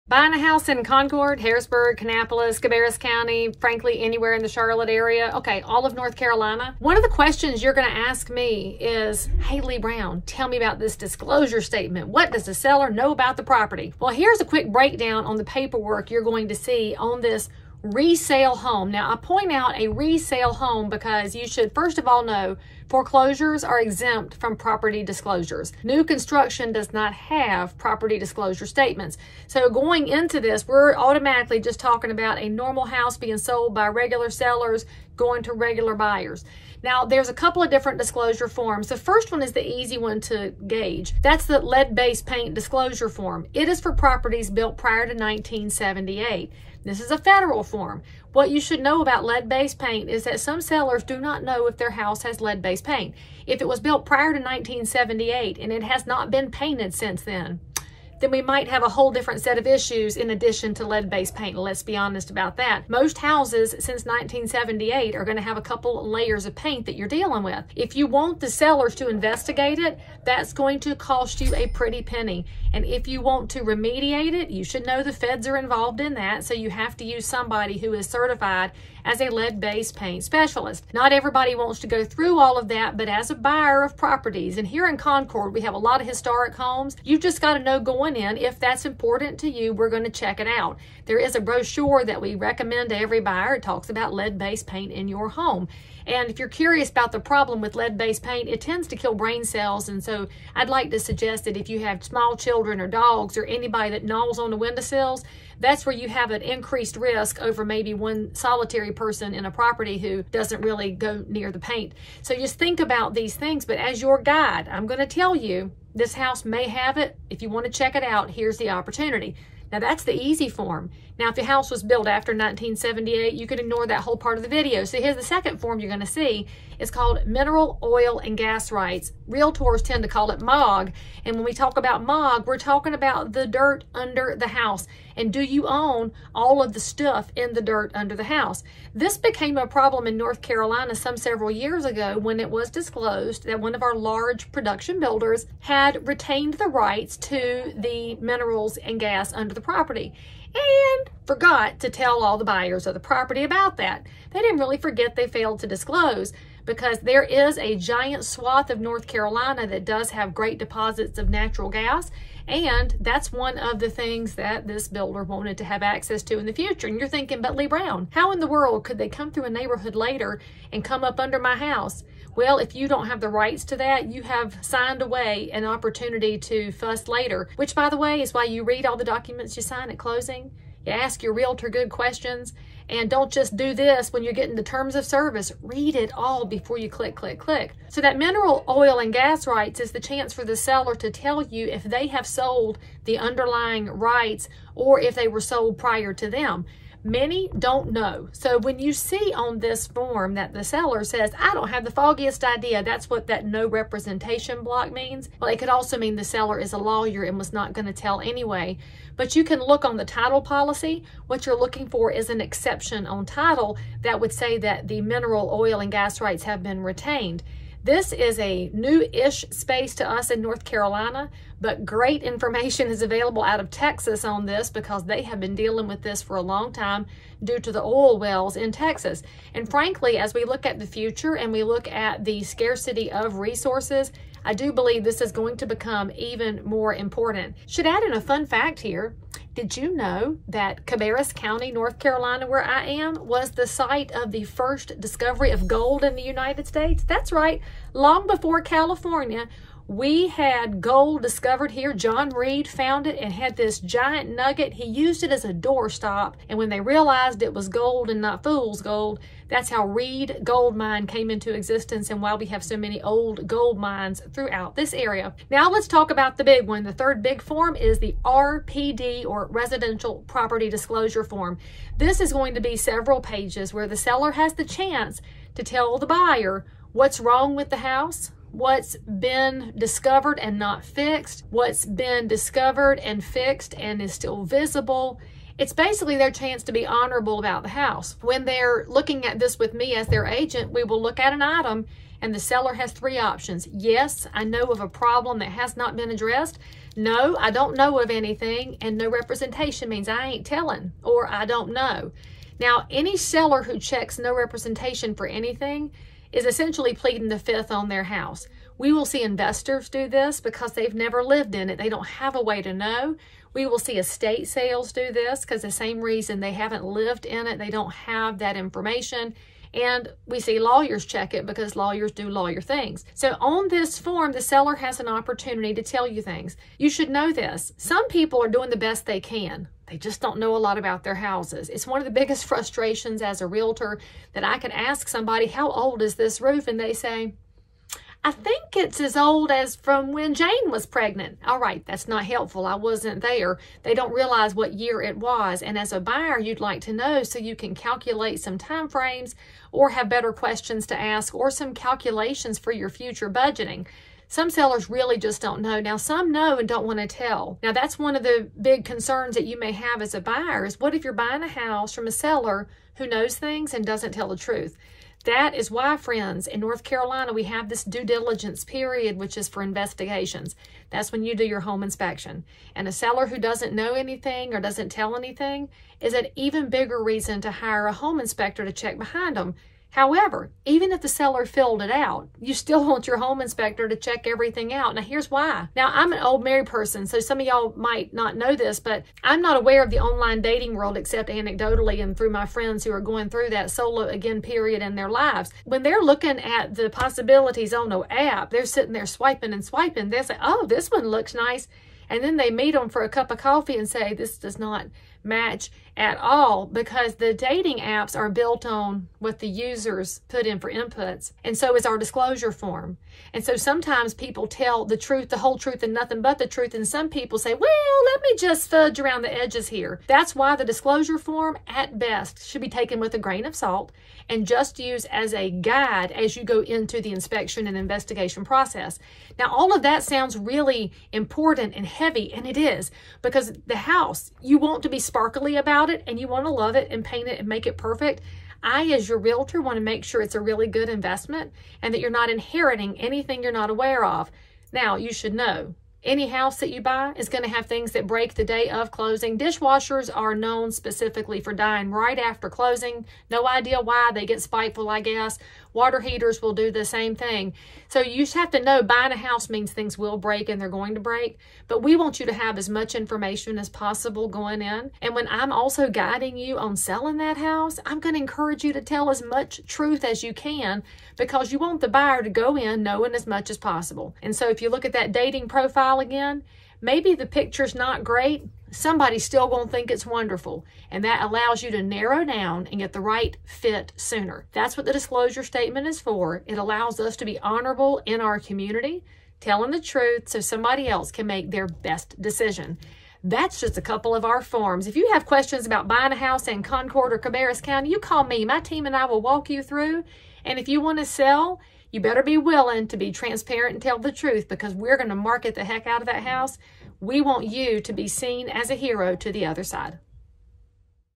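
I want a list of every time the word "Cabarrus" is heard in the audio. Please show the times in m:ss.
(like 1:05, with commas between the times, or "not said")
0:02, 4:00, 8:17.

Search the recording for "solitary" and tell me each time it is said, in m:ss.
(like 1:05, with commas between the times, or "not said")
1:48.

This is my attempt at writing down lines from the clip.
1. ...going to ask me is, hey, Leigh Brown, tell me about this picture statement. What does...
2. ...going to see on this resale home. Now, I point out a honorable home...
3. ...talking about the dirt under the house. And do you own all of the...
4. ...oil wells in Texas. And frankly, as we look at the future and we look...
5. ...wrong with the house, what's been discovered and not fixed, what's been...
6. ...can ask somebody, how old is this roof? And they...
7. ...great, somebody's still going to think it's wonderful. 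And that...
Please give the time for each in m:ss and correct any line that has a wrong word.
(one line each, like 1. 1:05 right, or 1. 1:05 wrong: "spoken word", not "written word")
1. 0:07 wrong: "disclosure", not "picture"
2. 0:16 wrong: "resale", not "honorable"
3. 2:12 right
4. 3:47 right
5. 4:37 right
6. 5:34 right
7. 7:58 right.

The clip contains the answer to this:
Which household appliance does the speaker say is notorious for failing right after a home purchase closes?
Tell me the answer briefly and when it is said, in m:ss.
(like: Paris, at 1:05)
Dishwashers, at 7:29.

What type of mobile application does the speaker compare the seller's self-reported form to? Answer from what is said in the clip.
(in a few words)
Dating apps.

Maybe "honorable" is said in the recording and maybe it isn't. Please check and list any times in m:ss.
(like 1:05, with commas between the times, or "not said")
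4:46, 8:07.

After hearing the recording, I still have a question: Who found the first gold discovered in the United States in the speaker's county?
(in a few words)
John Reed.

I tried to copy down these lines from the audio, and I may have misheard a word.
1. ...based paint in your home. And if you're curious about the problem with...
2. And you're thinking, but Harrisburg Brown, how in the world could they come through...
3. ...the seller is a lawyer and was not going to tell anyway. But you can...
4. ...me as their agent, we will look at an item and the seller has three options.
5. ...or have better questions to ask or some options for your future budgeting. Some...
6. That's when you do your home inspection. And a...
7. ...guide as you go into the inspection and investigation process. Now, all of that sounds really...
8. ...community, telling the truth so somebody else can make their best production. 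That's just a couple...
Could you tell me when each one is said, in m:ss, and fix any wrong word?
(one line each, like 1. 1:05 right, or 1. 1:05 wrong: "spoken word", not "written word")
1. 1:34 right
2. 2:46 wrong: "Leigh", not "Harrisburg"
3. 3:26 right
4. 4:49 right
5. 5:49 wrong: "calculations", not "options"
6. 6:10 right
7. 7:05 right
8. 8:08 wrong: "decision", not "production".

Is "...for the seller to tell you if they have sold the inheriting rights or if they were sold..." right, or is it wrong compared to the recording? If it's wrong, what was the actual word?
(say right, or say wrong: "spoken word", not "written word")
wrong: "underlying", not "inheriting".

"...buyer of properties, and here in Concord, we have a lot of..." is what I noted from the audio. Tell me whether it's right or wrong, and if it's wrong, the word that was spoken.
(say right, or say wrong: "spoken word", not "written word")
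right.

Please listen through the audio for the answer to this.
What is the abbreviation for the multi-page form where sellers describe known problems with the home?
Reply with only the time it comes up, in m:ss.
4:28.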